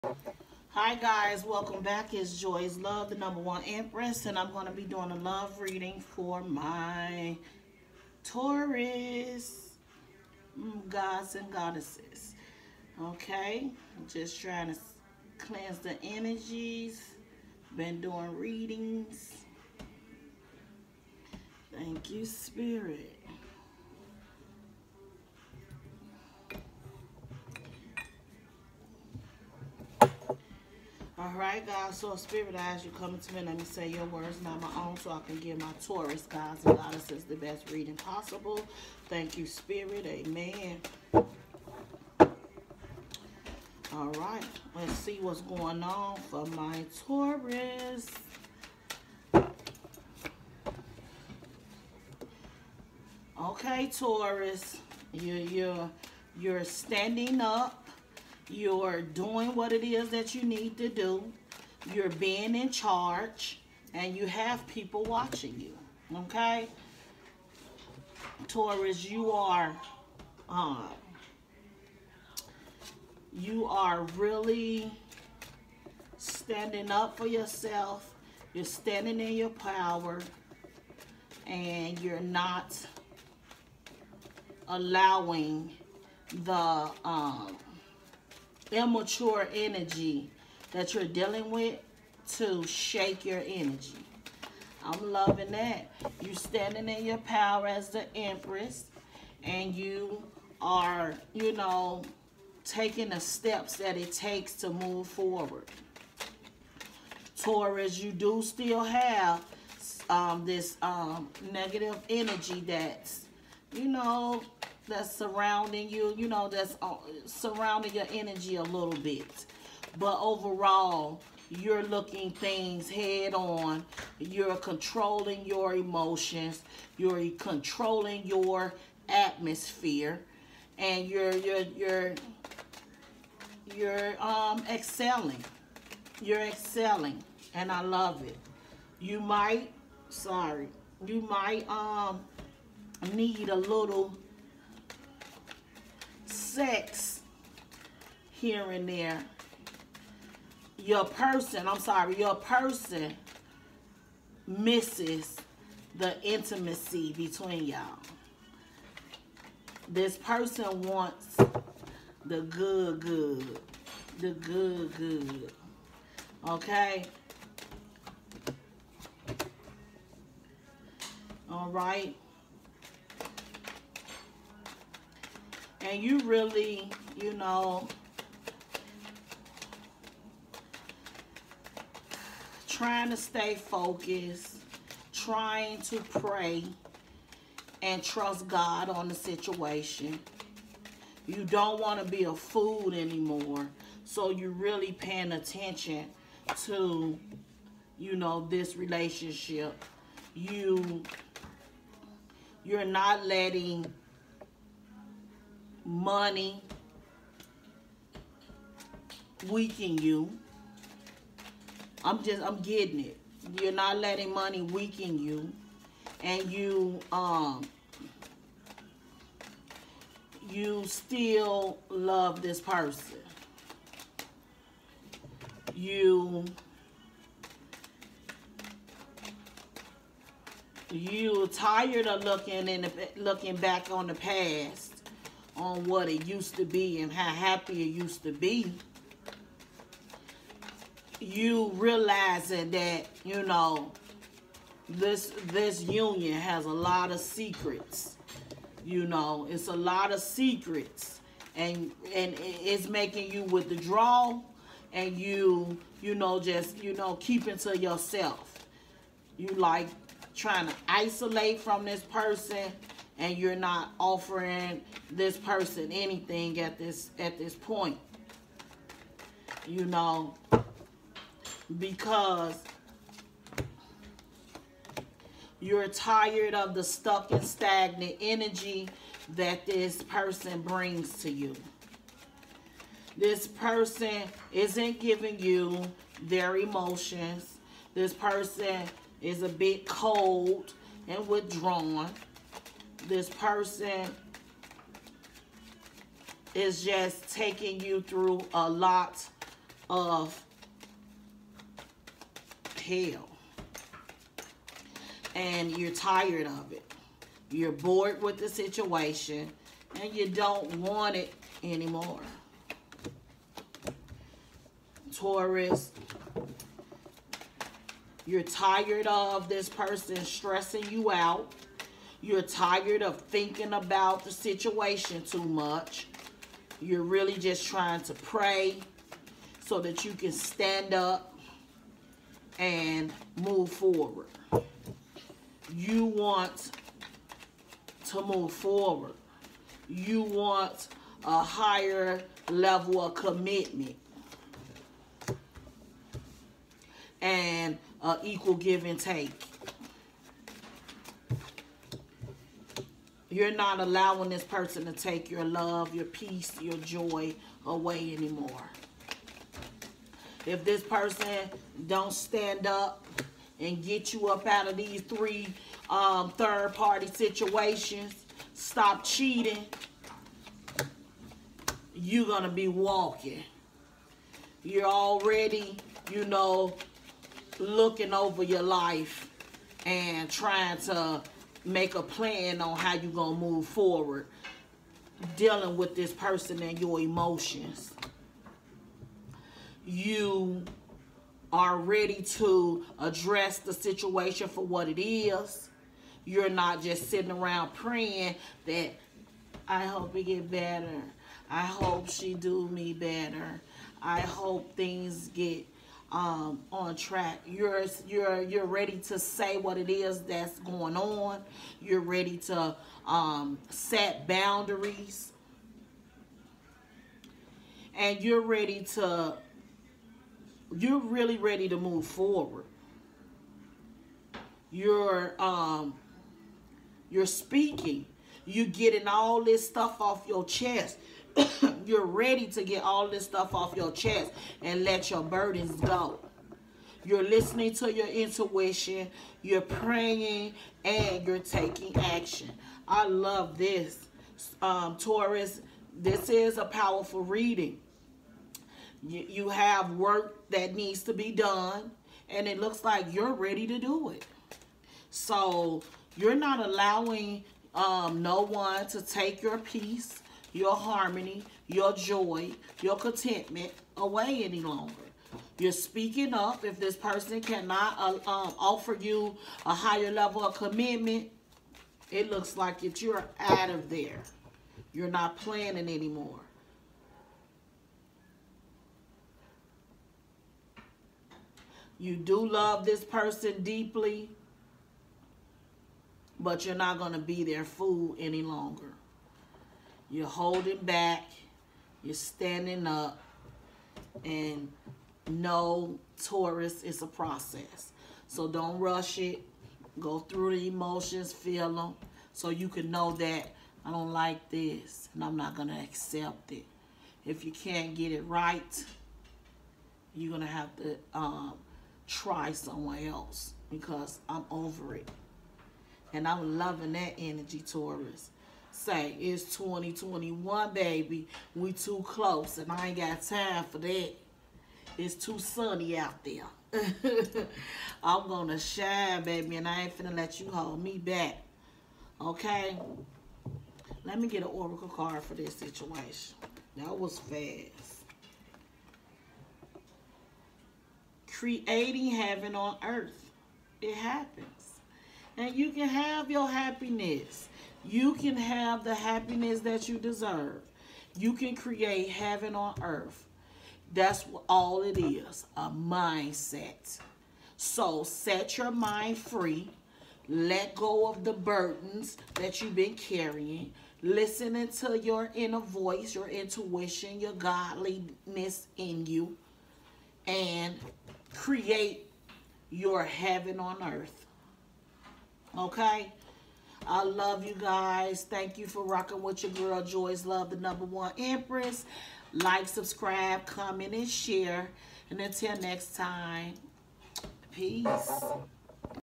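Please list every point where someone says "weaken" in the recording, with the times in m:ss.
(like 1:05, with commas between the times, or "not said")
3:29, 3:34.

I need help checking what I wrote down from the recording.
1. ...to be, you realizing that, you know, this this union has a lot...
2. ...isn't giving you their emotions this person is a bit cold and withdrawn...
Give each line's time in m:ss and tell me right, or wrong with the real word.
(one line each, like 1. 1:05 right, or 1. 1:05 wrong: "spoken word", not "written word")
1. 3:58 right
2. 4:44 right.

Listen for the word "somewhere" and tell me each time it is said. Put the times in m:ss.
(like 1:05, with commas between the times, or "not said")
8:32.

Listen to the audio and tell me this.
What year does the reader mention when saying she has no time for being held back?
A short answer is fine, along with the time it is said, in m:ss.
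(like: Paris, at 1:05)
2021, at 8:39.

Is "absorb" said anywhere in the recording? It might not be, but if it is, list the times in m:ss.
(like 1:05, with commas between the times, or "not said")
not said.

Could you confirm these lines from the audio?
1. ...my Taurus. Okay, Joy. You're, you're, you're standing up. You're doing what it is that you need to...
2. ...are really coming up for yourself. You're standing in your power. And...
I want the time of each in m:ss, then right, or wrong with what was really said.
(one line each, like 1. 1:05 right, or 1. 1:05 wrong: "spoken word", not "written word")
1. 0:46 wrong: "Taurus", not "Joy"
2. 1:13 wrong: "standing", not "coming".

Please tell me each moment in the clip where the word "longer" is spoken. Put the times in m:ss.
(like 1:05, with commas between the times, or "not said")
7:44, 8:08.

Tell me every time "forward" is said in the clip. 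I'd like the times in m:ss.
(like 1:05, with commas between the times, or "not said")
1:45, 5:33, 5:38, 6:23, 7:02.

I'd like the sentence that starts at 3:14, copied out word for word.
So you're really paying attention to, you know, this relationship.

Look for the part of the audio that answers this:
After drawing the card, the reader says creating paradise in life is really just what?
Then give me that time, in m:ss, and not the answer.
9:15.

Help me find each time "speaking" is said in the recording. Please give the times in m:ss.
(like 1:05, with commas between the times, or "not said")
7:07, 7:45.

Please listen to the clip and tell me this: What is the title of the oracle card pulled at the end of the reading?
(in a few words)
Creating heaven on earth.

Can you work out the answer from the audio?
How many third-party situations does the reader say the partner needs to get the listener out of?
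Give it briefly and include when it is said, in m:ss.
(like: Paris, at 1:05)
3, at 6:04.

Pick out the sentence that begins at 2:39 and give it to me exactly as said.
This person wants the good, good.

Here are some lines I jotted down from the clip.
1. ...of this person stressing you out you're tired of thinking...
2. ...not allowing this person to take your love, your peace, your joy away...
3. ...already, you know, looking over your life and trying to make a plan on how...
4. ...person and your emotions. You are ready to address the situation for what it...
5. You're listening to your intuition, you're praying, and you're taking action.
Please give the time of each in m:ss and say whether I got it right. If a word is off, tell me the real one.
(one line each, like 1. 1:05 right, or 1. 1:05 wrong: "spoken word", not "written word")
1. 5:19 right
2. 5:53 right
3. 6:14 right
4. 6:26 right
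5. 7:17 right.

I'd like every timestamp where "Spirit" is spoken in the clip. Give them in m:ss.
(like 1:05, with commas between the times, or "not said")
0:22, 0:32, 0:39.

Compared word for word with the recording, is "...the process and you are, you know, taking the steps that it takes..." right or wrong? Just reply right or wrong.
wrong.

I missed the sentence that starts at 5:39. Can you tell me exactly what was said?
You want a higher level of commitment and uh, equal give and take.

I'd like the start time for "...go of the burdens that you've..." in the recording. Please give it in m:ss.
9:20.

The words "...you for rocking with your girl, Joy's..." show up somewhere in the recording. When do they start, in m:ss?
9:38.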